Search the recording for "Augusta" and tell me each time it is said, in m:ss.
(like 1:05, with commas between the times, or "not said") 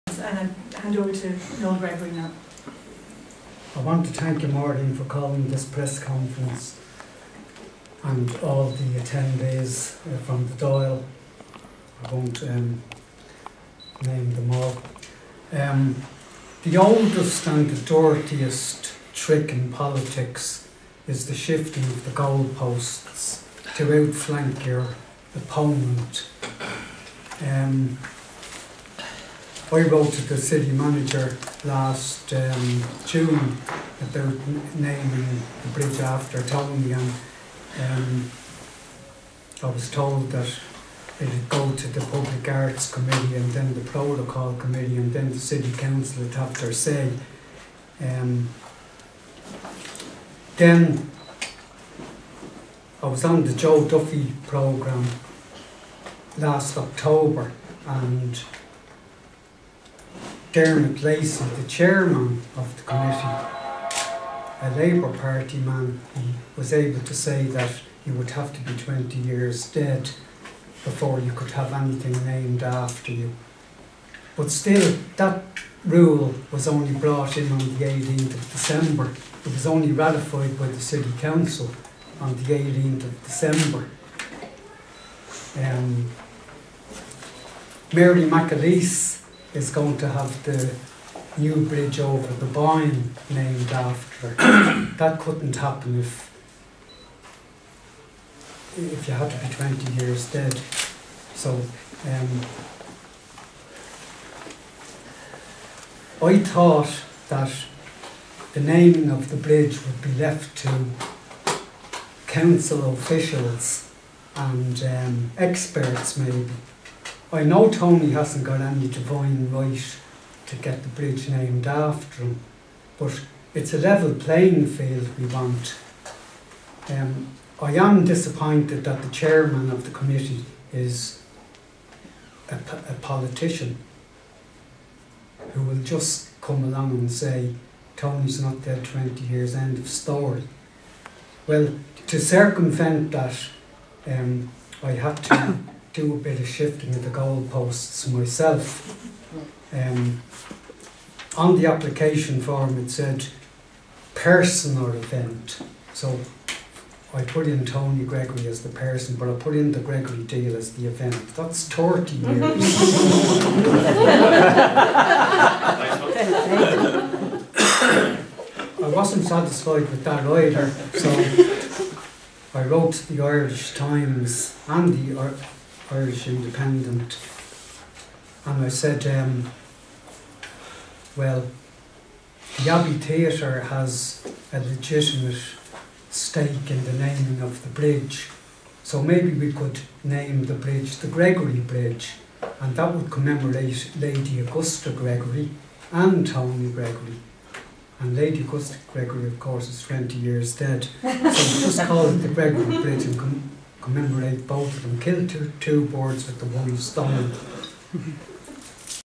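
3:14, 3:18.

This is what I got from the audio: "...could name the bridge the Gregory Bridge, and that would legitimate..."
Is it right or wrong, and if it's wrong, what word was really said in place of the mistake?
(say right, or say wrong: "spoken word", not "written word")
wrong: "commemorate", not "legitimate".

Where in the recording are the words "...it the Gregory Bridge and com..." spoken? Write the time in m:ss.
3:22.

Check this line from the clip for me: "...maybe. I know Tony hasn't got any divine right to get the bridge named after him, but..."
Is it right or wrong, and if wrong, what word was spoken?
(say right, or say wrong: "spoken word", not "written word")
right.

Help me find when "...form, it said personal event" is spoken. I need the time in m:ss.
2:32.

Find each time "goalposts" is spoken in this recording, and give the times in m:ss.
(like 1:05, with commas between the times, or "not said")
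0:22, 2:27.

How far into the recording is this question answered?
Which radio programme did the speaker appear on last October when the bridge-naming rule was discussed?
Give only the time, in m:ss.
0:53.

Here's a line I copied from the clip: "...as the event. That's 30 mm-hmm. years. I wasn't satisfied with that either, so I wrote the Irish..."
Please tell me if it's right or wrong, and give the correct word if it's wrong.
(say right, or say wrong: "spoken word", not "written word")
right.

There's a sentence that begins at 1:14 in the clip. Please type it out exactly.
But still, that rule was only brought in on the 18th of December.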